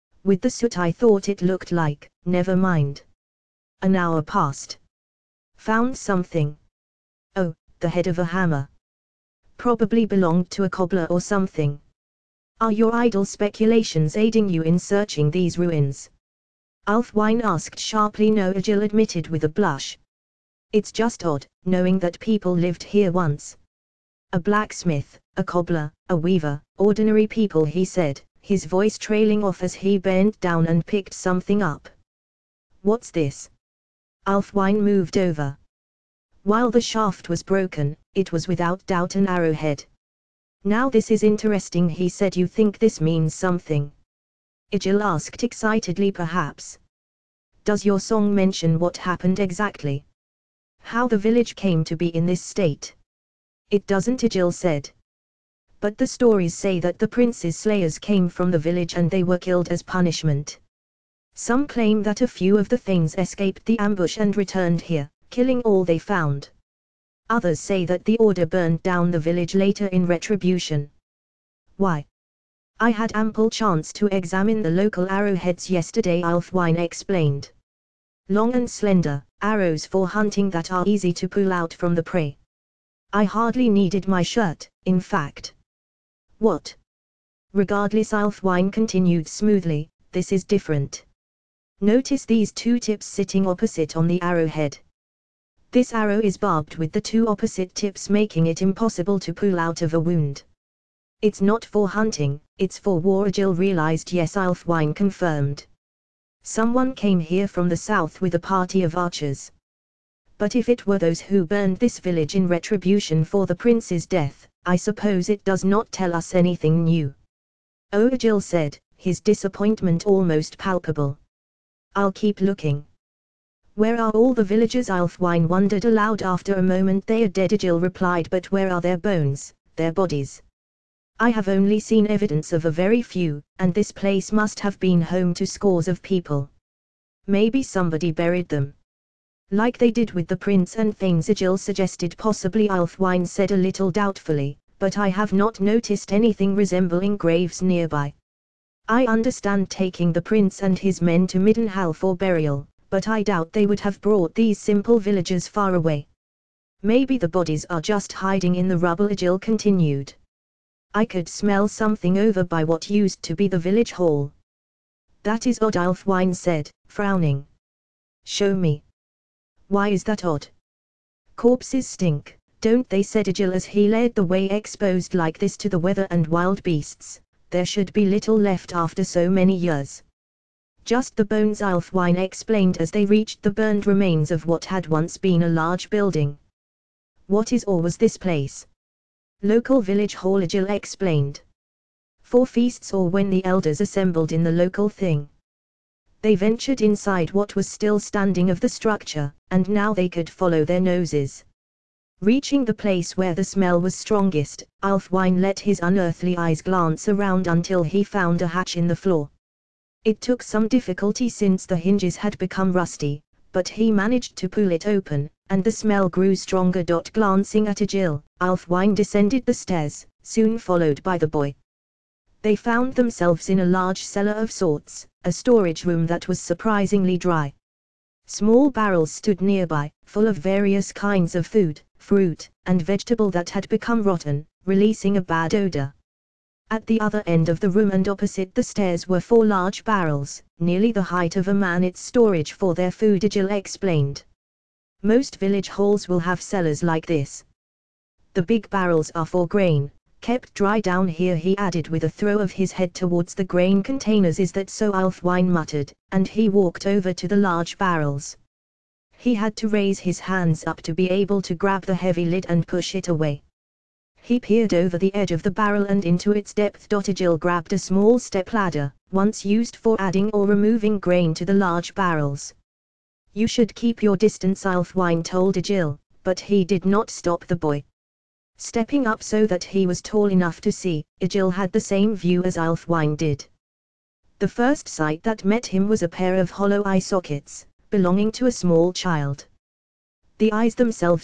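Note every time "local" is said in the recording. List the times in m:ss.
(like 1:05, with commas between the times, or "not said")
1:14, 3:09, 3:14.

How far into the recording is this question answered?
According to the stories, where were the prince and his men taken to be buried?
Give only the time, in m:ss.
2:31.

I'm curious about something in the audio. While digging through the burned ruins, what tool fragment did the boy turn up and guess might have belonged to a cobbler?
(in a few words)
Head of a hammer.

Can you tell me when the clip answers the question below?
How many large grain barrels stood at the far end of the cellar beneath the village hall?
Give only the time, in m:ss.
3:59.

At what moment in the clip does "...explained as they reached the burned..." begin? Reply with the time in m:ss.
3:02.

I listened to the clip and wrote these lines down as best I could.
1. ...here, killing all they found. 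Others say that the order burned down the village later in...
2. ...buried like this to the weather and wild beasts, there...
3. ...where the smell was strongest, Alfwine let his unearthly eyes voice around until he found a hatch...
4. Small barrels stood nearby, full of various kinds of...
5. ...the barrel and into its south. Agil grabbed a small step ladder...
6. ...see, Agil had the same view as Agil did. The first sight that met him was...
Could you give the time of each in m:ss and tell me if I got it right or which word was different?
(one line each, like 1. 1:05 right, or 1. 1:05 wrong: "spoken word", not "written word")
1. 1:04 right
2. 2:54 wrong: "exposed", not "buried"
3. 3:23 wrong: "glance", not "voice"
4. 3:48 right
5. 4:25 wrong: "depth", not "south"
6. 4:40 wrong: "Alfwine", not "Agil".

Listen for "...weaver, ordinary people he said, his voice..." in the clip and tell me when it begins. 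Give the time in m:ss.
0:26.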